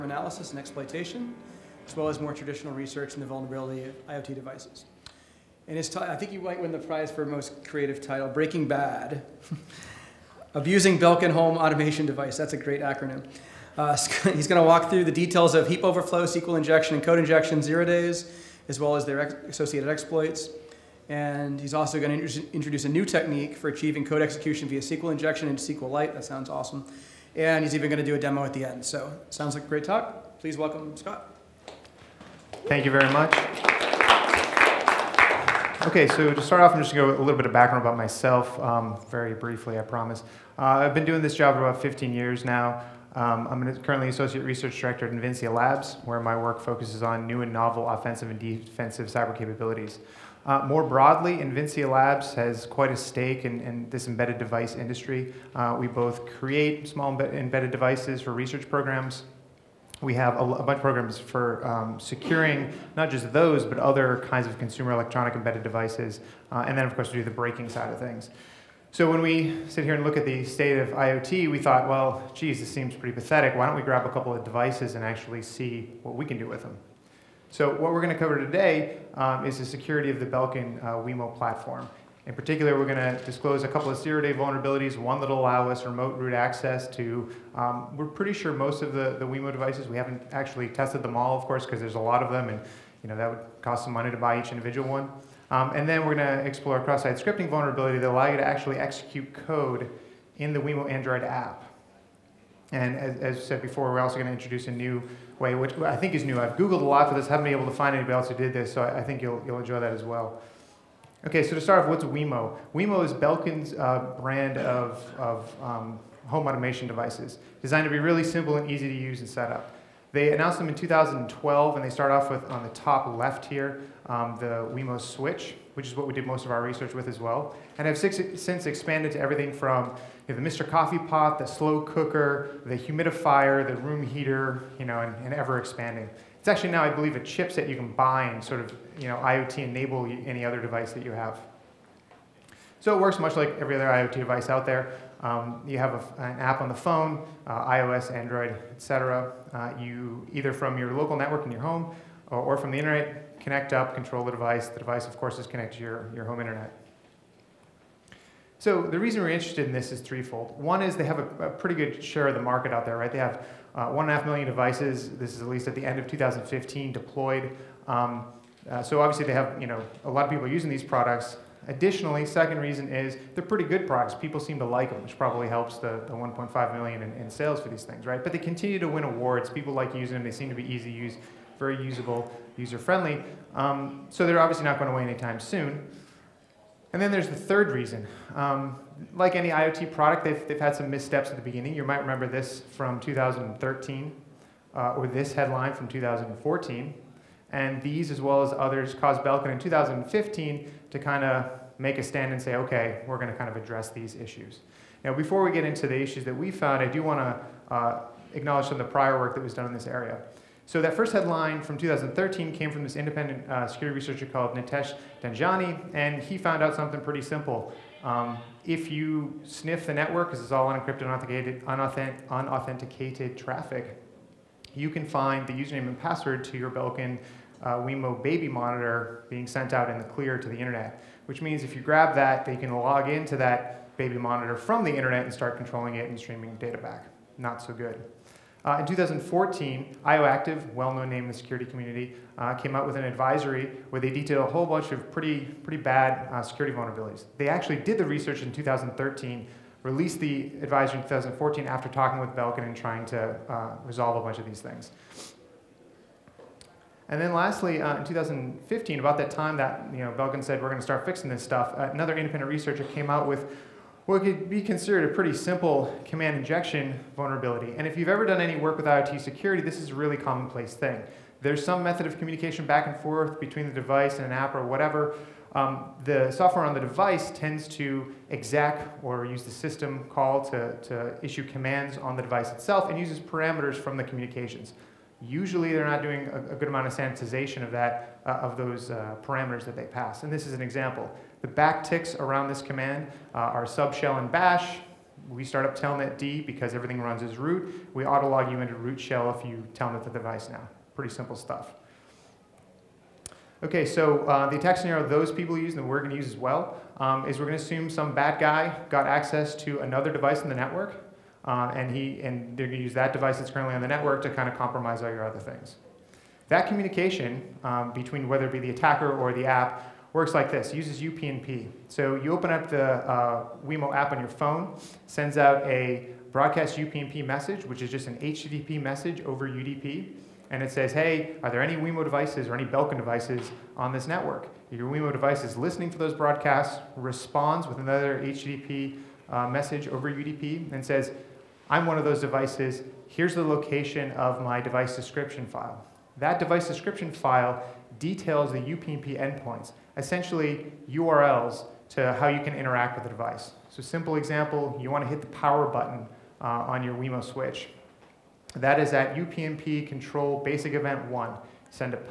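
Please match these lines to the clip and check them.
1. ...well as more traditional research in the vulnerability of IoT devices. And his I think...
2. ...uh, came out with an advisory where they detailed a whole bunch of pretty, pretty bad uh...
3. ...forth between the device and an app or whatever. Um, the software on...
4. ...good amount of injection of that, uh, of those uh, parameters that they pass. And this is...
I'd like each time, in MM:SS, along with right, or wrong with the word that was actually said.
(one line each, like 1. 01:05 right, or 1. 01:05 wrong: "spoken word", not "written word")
1. 00:01 right
2. 04:02 right
3. 04:32 right
4. 04:46 wrong: "sanitization", not "injection".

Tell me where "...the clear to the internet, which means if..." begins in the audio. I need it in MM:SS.
03:49.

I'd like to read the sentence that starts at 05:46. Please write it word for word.
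That device description file details the UPnP endpoints, essentially URLs to how you can interact with the device.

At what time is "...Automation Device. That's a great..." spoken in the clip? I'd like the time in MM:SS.
00:11.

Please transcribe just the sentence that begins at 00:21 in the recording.
And he's also going to introduce a new technique for achieving code execution via SQL injection into SQLite.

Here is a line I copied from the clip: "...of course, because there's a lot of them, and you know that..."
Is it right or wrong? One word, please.
right.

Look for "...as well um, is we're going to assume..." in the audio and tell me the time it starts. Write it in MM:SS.
05:06.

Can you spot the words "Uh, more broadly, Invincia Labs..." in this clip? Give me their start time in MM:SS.
00:50.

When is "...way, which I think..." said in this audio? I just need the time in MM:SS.
01:45.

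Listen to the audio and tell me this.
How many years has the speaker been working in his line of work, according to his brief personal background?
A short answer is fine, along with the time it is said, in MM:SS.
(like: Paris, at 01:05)
15, at 00:41.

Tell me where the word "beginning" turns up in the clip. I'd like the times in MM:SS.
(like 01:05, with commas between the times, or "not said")
03:11.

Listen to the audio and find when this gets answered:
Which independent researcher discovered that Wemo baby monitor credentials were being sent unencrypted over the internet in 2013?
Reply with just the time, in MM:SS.
03:34.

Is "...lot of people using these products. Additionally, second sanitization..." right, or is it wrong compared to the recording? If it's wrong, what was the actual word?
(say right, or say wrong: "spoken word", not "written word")
wrong: "reason", not "sanitization".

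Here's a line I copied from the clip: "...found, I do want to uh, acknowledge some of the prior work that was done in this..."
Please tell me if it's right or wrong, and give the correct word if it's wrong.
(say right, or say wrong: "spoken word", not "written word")
right.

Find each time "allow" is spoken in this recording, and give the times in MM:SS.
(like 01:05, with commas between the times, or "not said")
01:25, 01:38.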